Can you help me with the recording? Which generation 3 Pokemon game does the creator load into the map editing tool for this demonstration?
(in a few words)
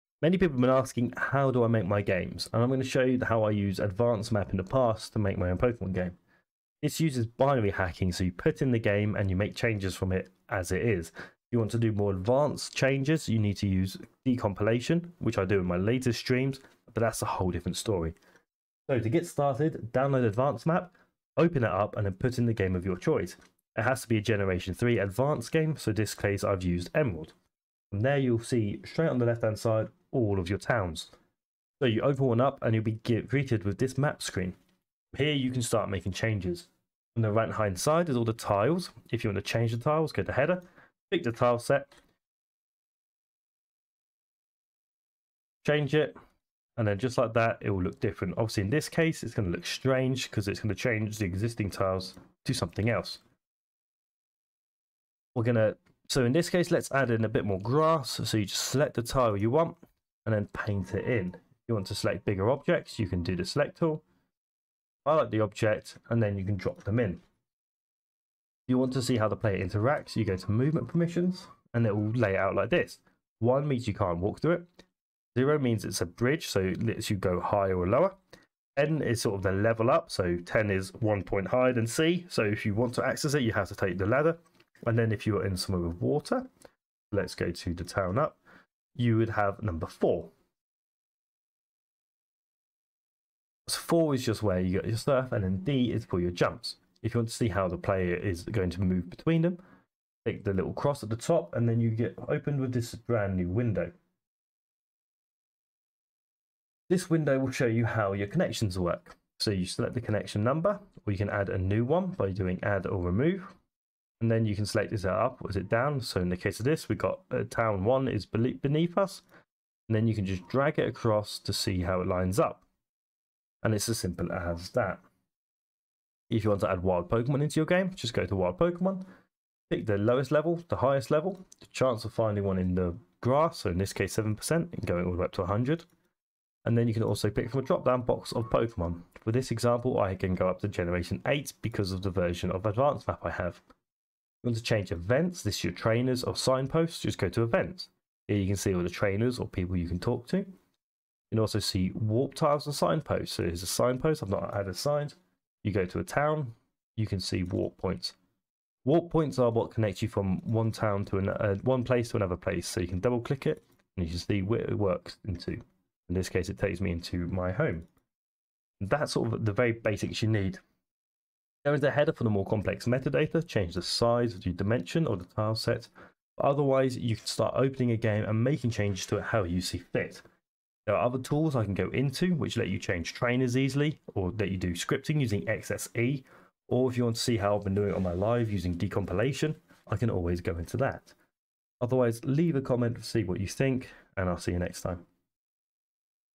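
Emerald.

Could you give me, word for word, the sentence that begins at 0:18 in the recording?
So to get started, download Advance Map, open it up and then put in the game of your choice.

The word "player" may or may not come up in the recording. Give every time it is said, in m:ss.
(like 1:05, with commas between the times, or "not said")
1:09, 1:37.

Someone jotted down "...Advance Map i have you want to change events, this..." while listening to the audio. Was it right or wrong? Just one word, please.
right.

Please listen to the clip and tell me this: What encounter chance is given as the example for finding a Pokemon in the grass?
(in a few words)
7%.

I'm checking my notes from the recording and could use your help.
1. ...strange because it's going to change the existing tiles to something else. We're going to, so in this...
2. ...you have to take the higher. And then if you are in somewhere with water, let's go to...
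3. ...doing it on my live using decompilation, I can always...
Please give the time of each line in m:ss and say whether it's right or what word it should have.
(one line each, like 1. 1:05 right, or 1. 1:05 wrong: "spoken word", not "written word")
1. 0:49 right
2. 1:23 wrong: "ladder", not "higher"
3. 3:07 right.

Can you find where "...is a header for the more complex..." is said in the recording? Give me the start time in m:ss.
2:51.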